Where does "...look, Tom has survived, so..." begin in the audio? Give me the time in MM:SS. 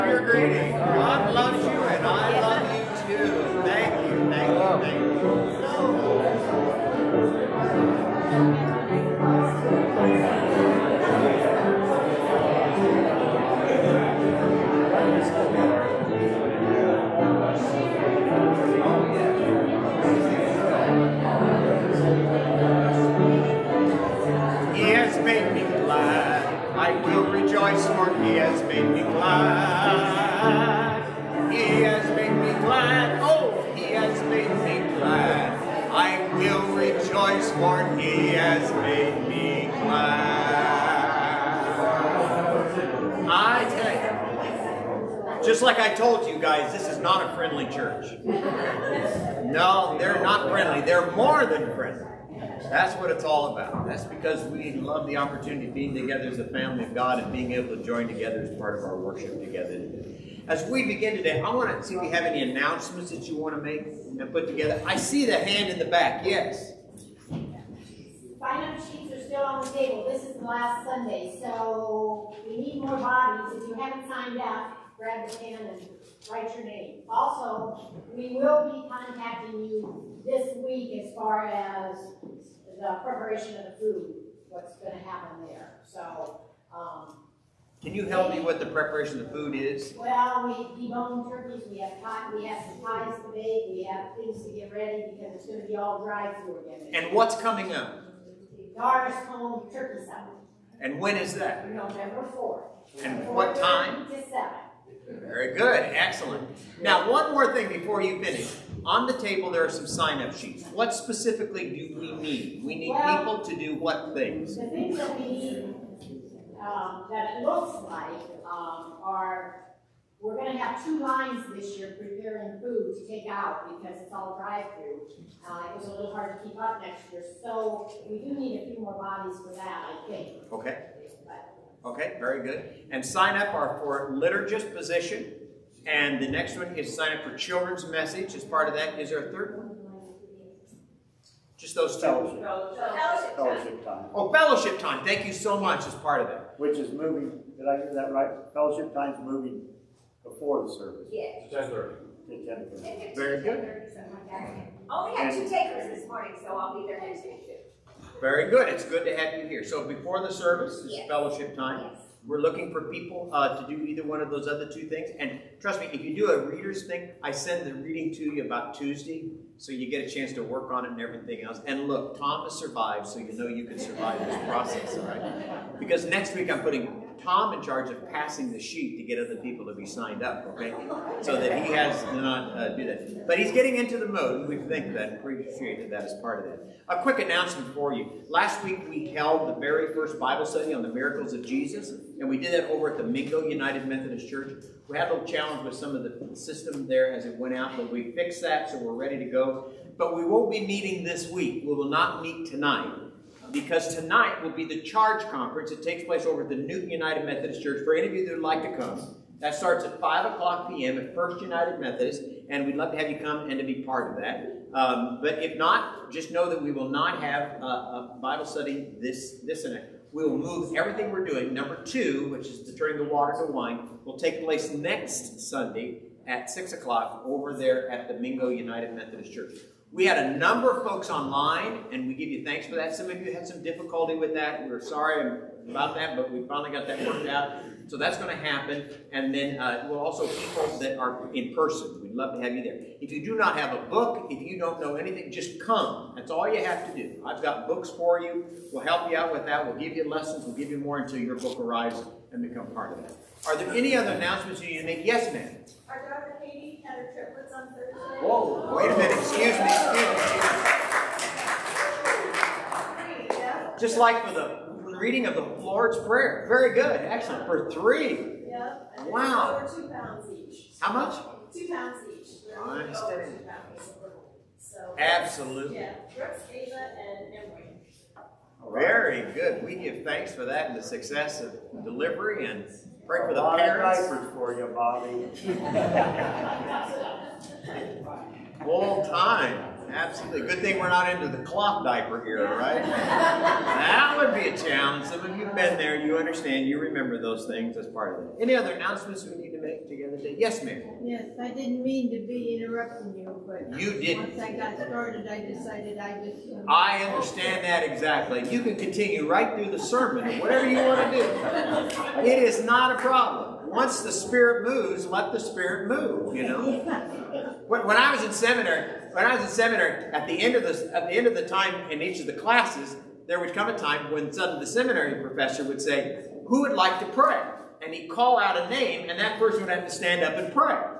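02:51.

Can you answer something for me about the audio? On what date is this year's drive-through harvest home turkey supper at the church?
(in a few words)
November 4th.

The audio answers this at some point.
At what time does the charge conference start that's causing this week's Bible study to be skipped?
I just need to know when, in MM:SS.
03:29.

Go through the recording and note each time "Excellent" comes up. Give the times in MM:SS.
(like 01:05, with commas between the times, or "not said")
01:45, 04:27.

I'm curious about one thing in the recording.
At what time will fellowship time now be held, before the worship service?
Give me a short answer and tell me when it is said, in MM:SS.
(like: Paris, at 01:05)
10:30, at 02:31.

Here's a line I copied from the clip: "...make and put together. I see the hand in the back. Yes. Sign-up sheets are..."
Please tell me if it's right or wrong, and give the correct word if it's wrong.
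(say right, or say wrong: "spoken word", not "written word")
right.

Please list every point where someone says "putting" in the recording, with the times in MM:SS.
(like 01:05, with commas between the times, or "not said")
02:56.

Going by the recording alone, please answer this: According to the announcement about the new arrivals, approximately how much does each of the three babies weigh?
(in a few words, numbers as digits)
Over 2 pounds.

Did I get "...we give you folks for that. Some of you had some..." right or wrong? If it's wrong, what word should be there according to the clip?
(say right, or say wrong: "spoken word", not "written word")
wrong: "thanks", not "folks".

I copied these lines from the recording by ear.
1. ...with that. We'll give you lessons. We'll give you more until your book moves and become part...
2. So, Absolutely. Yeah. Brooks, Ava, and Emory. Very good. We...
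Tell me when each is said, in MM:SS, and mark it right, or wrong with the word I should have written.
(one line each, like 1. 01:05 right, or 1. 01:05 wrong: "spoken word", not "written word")
1. 04:09 wrong: "arrives", not "moves"
2. 04:34 right.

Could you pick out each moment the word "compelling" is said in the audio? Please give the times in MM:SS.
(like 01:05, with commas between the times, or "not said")
not said.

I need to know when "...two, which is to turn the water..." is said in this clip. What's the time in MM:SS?
03:41.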